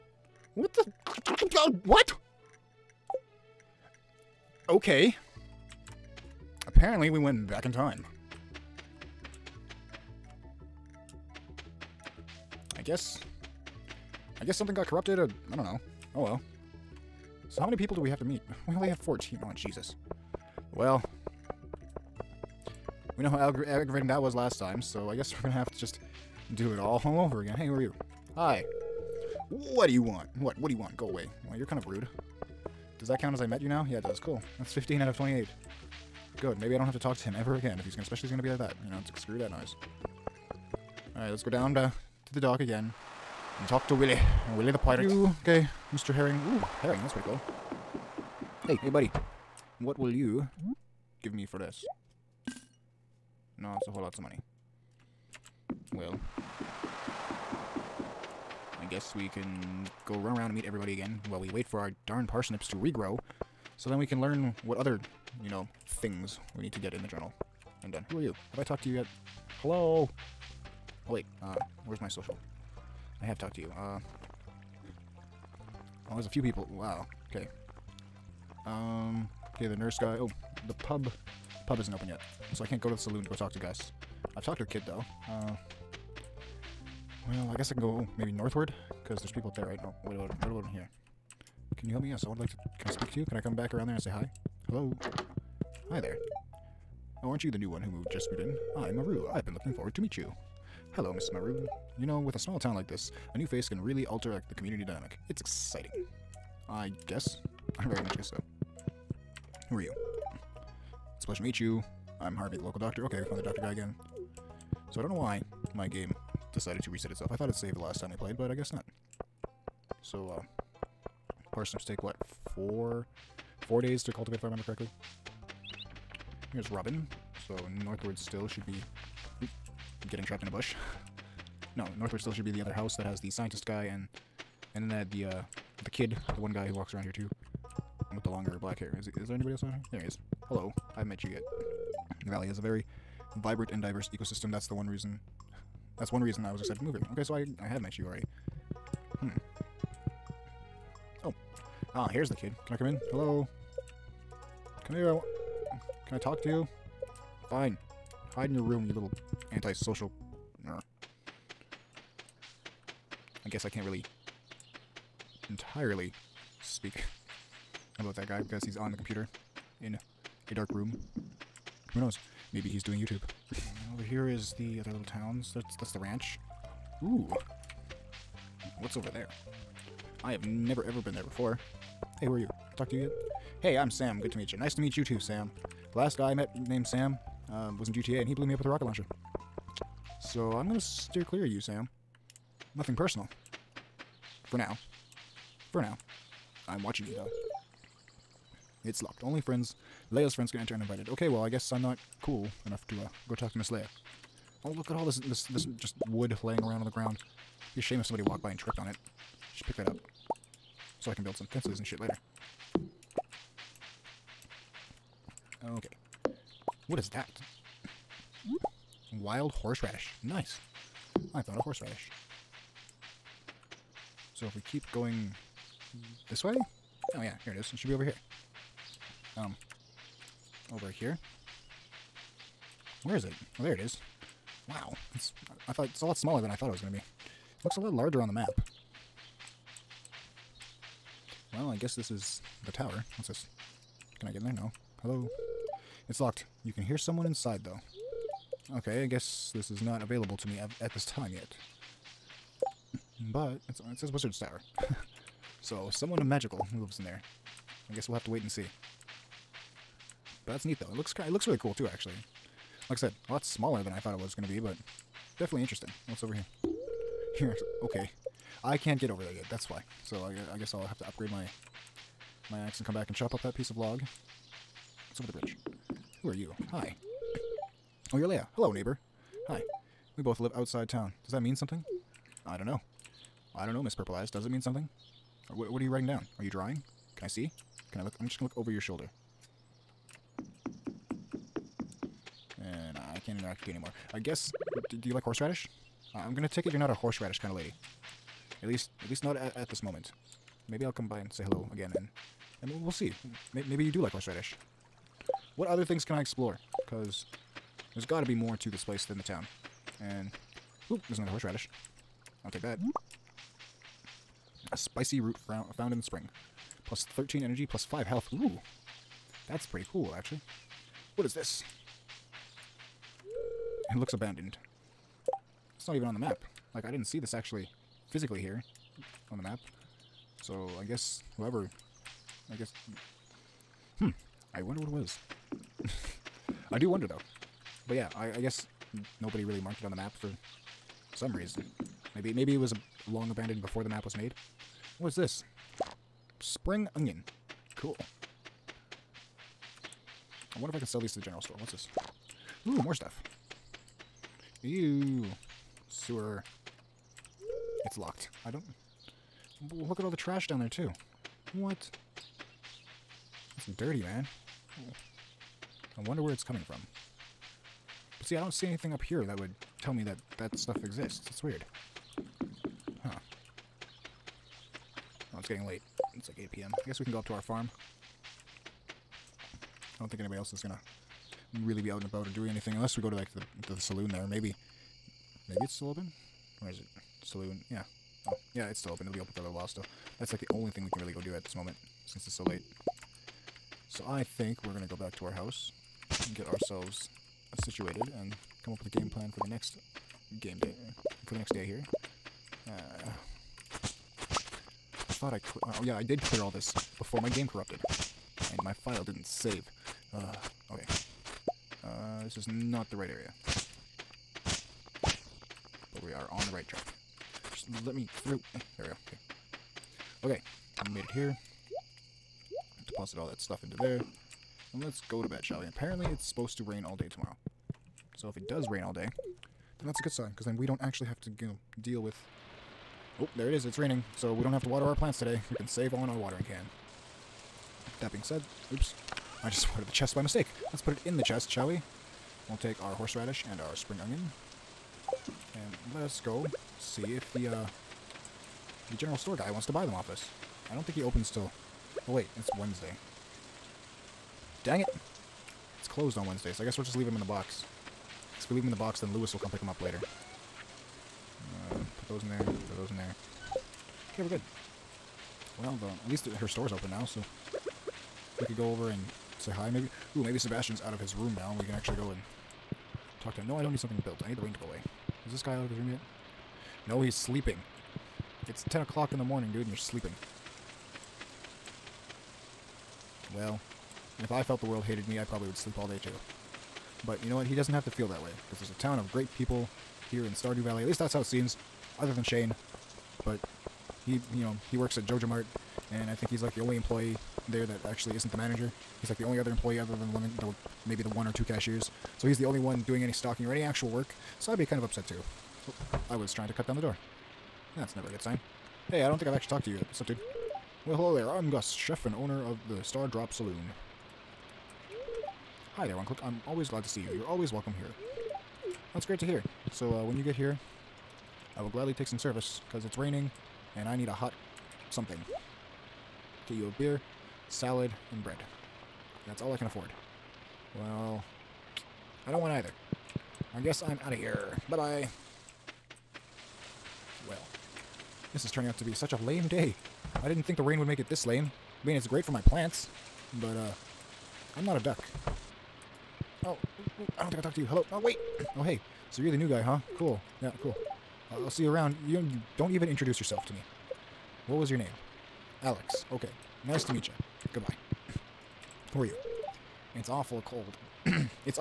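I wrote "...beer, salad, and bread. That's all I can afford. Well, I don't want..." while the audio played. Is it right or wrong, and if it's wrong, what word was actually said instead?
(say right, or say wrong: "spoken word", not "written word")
right.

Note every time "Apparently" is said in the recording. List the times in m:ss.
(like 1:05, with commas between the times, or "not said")
0:06, 7:05.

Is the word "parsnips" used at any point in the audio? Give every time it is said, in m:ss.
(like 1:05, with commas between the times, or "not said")
1:02, 2:01.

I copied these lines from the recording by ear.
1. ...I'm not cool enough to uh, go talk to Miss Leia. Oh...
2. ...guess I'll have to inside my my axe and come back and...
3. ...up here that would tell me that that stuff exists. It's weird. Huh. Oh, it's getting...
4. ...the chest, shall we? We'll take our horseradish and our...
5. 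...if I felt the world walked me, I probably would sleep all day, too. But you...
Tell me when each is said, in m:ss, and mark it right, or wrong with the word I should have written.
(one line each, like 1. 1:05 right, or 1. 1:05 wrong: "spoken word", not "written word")
1. 3:21 right
2. 4:30 wrong: "upgrade", not "inside"
3. 6:08 right
4. 7:21 right
5. 8:04 wrong: "hated", not "walked".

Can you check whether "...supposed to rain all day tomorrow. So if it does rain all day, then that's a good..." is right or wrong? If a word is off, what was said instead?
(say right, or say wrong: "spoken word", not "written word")
right.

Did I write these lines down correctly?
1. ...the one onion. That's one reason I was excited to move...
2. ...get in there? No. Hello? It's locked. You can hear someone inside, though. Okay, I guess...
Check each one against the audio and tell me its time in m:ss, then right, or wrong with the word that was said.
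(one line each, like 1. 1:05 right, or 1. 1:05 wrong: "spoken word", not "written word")
1. 2:24 wrong: "reason", not "onion"
2. 4:04 right.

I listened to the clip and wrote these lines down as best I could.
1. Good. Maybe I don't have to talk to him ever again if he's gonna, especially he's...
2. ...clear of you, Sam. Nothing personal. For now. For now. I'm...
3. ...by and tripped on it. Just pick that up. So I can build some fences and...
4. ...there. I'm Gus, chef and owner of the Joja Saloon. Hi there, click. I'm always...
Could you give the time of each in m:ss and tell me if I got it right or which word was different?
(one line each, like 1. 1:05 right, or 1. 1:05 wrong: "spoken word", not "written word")
1. 0:36 right
2. 3:11 right
3. 3:28 right
4. 8:31 wrong: "Stardrop", not "Joja".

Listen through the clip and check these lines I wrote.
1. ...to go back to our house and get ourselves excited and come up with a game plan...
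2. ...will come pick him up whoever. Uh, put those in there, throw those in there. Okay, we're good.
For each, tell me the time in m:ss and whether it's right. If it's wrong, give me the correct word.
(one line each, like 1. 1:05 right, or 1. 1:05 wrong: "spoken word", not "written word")
1. 6:34 wrong: "situated", not "excited"
2. 7:39 wrong: "later", not "whoever".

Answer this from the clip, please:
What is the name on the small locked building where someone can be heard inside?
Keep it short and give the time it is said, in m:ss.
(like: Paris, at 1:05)
Wizard's Tower, at 4:14.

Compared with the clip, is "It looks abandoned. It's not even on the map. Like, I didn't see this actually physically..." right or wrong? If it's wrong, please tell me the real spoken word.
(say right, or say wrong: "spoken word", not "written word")
right.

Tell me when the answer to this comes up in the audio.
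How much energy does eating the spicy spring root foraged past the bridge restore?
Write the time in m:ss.
5:16.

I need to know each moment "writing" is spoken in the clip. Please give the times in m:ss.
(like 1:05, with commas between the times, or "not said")
4:45.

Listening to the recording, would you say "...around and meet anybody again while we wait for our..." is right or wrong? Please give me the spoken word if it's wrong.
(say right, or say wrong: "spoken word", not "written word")
wrong: "everybody", not "anybody".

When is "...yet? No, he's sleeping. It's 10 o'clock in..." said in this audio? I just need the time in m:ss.
7:55.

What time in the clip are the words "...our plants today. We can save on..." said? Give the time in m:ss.
7:14.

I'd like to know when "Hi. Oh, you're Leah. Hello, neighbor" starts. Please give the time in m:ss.
4:36.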